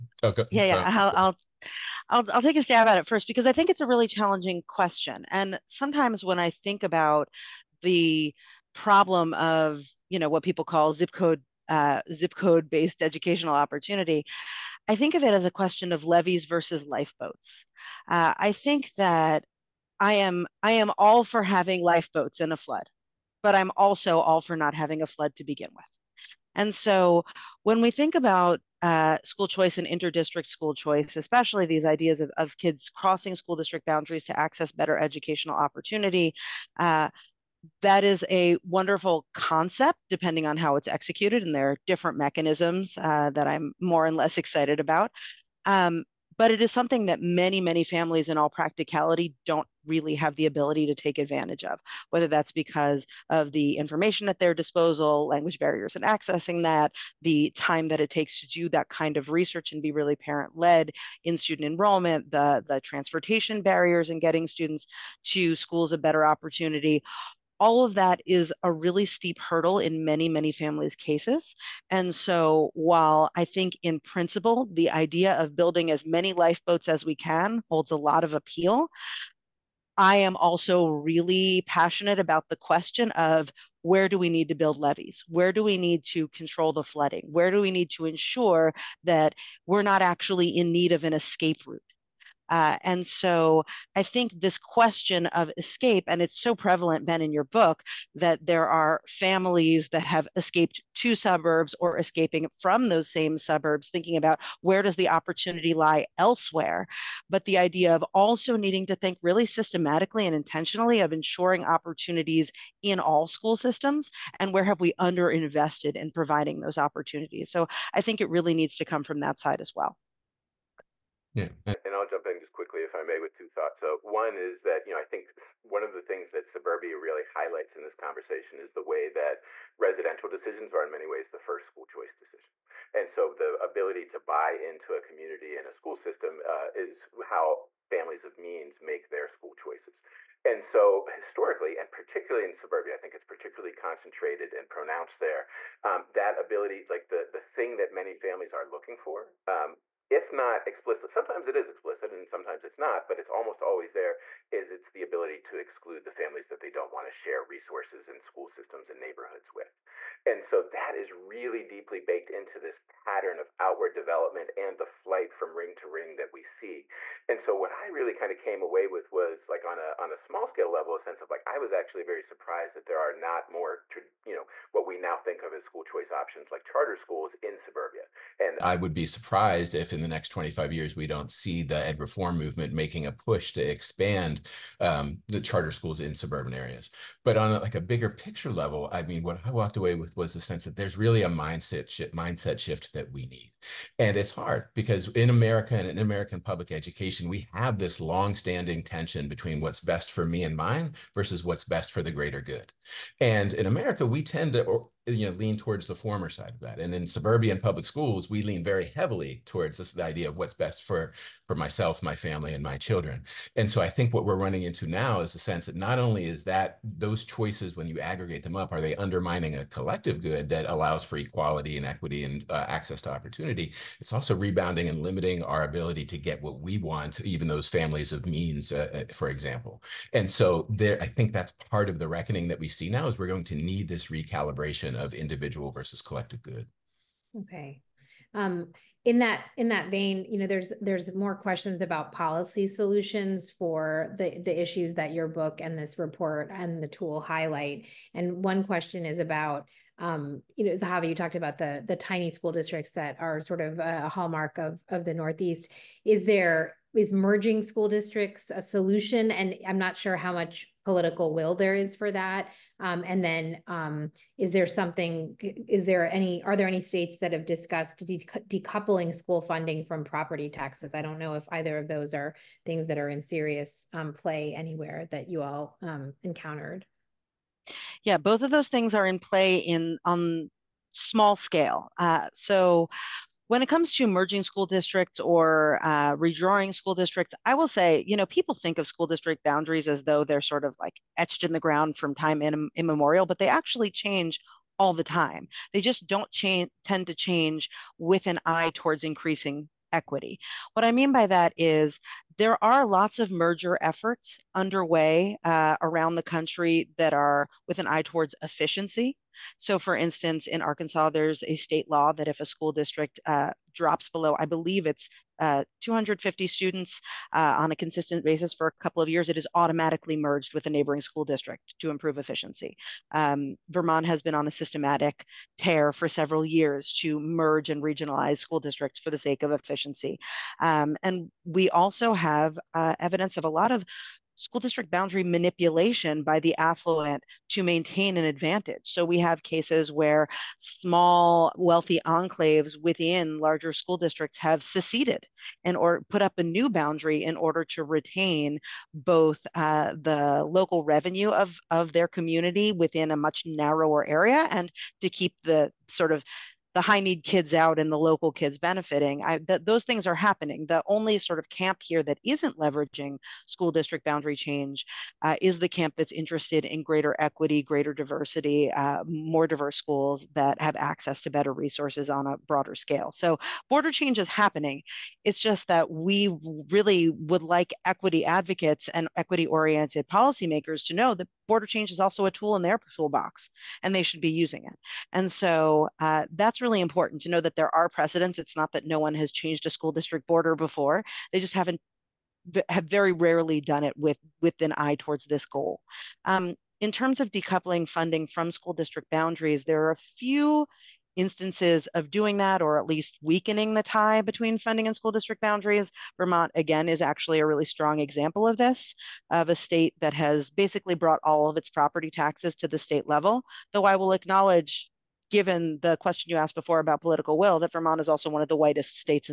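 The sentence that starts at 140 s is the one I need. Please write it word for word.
And so historically, and particularly in suburbia, I think it's particularly concentrated and pronounced there.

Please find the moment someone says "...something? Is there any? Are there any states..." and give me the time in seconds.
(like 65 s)
264 s.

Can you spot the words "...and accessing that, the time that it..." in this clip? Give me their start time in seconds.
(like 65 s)
55 s.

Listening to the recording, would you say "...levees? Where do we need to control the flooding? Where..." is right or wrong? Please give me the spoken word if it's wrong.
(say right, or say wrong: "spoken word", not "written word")
right.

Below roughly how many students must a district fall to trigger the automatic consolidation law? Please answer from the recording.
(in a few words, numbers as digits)
250.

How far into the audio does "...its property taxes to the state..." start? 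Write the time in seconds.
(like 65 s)
411 s.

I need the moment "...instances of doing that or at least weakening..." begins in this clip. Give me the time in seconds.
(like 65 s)
401 s.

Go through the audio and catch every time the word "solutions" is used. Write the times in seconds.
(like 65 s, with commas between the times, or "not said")
242 s, 258 s.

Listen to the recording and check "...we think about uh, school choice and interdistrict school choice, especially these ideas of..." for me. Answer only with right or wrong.
right.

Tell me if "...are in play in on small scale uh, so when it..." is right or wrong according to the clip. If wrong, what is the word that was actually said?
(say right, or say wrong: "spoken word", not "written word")
right.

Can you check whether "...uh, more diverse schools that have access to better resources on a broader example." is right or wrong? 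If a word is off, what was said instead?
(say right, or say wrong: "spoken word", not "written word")
wrong: "scale", not "example".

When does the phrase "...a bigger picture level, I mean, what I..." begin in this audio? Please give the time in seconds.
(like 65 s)
187 s.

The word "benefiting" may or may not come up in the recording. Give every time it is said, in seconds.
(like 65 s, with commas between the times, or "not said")
358 s.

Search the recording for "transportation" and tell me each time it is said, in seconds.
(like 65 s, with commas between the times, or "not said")
62 s.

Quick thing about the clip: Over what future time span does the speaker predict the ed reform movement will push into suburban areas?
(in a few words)
25 years.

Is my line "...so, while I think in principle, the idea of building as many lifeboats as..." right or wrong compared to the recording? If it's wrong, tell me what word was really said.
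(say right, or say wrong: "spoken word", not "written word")
right.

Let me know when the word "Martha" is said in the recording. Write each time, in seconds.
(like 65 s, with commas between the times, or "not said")
not said.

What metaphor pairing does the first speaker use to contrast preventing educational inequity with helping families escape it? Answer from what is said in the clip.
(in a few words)
Levees versus lifeboats.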